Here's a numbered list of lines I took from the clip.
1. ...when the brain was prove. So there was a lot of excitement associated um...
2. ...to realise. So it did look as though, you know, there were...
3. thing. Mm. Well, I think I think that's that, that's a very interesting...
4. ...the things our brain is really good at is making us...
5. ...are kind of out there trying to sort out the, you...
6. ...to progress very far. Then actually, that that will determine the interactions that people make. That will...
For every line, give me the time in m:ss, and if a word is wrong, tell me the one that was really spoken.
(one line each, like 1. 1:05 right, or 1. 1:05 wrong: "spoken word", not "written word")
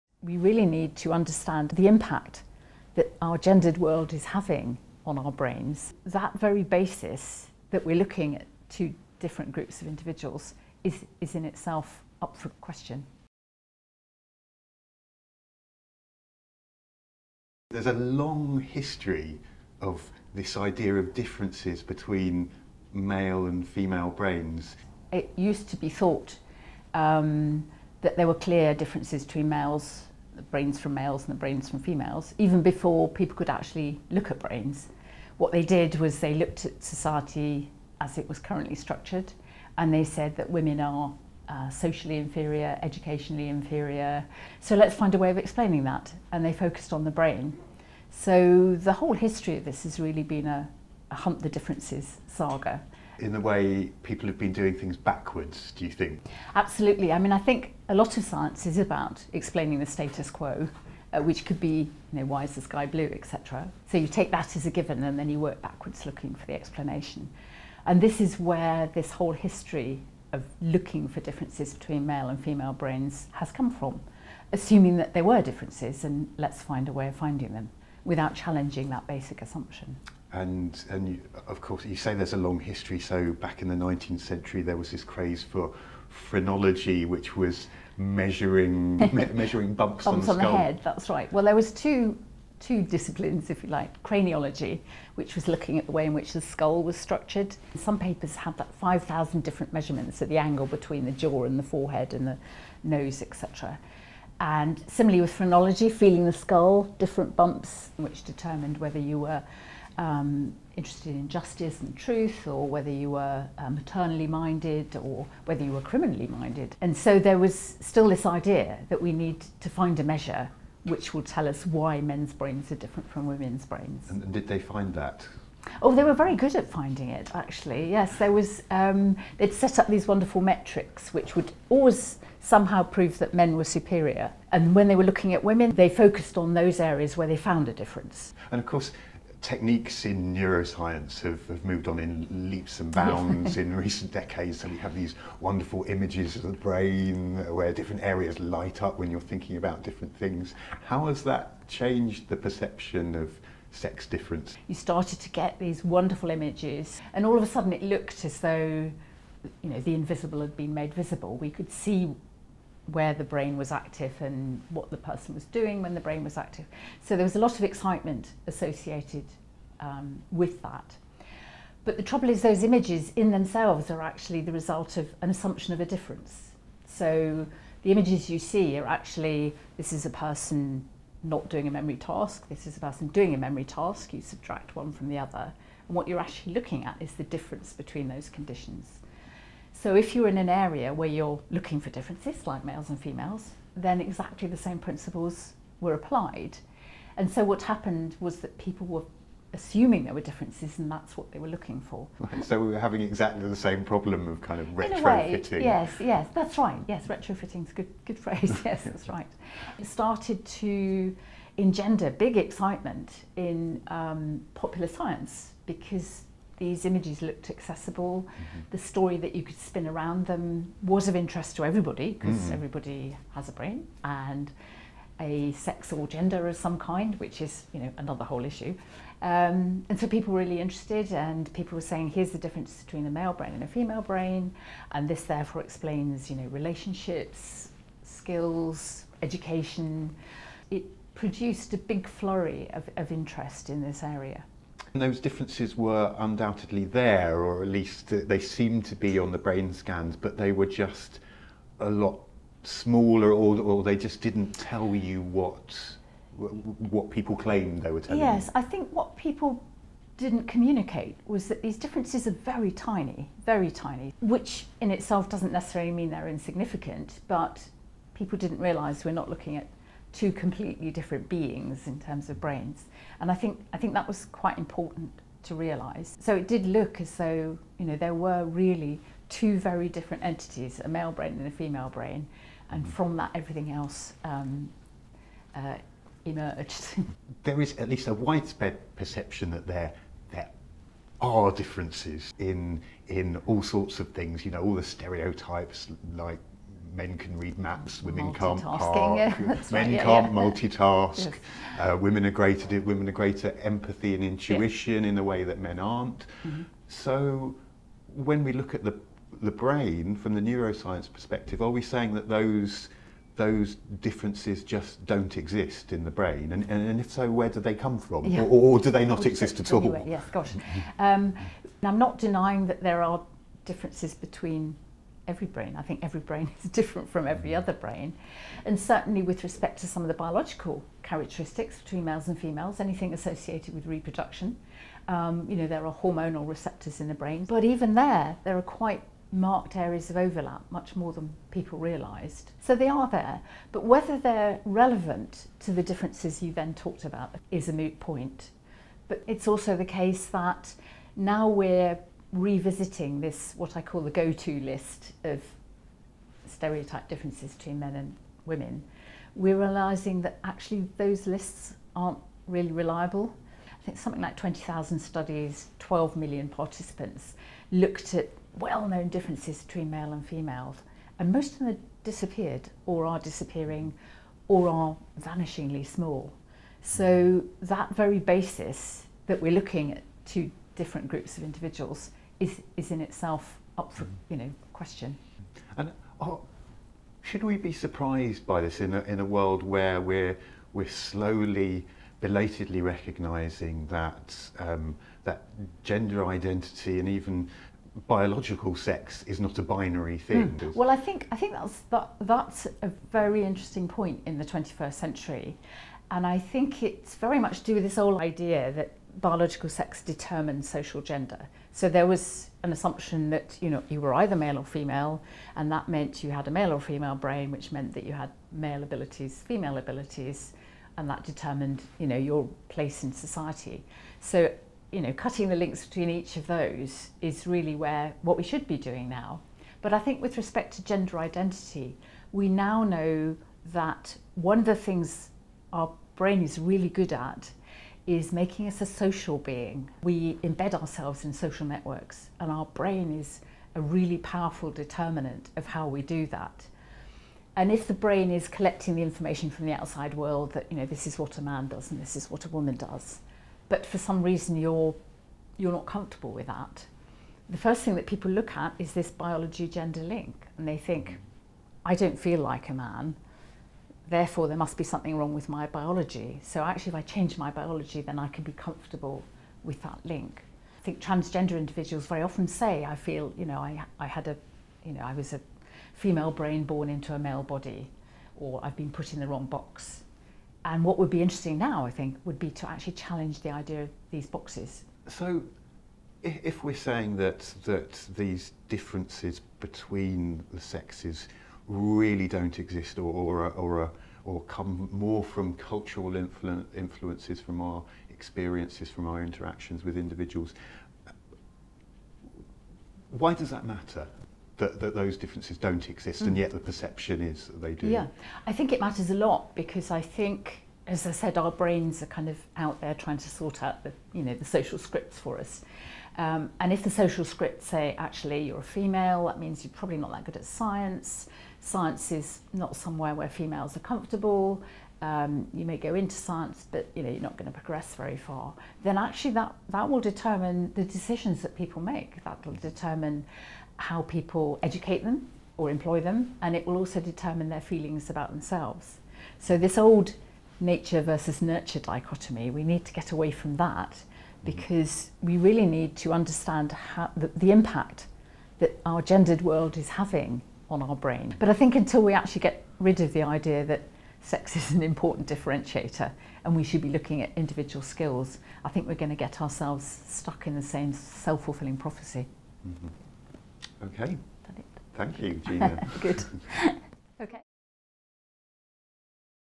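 1. 2:45 wrong: "active", not "prove"
2. 4:35 right
3. 6:40 right
4. 7:14 right
5. 8:32 right
6. 8:47 wrong: "decisions", not "interactions".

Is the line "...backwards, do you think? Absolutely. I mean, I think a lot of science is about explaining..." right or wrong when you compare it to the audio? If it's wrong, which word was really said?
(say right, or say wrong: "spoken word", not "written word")
right.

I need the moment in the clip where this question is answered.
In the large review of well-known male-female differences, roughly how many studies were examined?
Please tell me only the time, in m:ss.
6:04.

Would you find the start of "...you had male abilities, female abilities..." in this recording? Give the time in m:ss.
6:58.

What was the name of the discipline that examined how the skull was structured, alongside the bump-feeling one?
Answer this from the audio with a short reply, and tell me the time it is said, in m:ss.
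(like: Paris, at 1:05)
Craniology, at 1:34.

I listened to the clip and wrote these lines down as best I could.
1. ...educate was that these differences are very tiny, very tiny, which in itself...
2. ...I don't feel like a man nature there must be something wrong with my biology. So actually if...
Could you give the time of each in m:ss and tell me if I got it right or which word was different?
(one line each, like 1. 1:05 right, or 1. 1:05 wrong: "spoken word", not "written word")
1. 4:20 wrong: "communicate", not "educate"
2. 7:41 wrong: "therefore", not "nature".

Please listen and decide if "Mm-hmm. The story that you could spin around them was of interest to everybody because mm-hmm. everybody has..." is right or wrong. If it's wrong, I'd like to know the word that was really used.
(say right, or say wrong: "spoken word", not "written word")
right.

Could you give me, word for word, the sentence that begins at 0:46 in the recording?
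And they focused on the brain.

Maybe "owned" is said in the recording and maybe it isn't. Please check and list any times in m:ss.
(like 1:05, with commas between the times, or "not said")
not said.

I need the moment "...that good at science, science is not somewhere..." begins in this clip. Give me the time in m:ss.
8:40.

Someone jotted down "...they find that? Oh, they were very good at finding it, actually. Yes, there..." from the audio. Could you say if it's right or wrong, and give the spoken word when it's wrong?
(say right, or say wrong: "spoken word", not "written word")
right.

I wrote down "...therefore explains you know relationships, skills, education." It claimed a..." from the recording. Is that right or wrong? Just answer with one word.
wrong.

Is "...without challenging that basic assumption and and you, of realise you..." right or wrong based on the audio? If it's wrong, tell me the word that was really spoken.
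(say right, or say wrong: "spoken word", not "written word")
wrong: "course", not "realise".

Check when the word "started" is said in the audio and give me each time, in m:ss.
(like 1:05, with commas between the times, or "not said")
2:34, 3:29.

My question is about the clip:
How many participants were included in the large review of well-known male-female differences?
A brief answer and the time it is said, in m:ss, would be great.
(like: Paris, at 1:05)
12 million, at 6:05.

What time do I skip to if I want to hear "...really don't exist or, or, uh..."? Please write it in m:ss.
8:11.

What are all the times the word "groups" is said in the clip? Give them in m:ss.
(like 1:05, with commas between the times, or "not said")
0:09, 6:21.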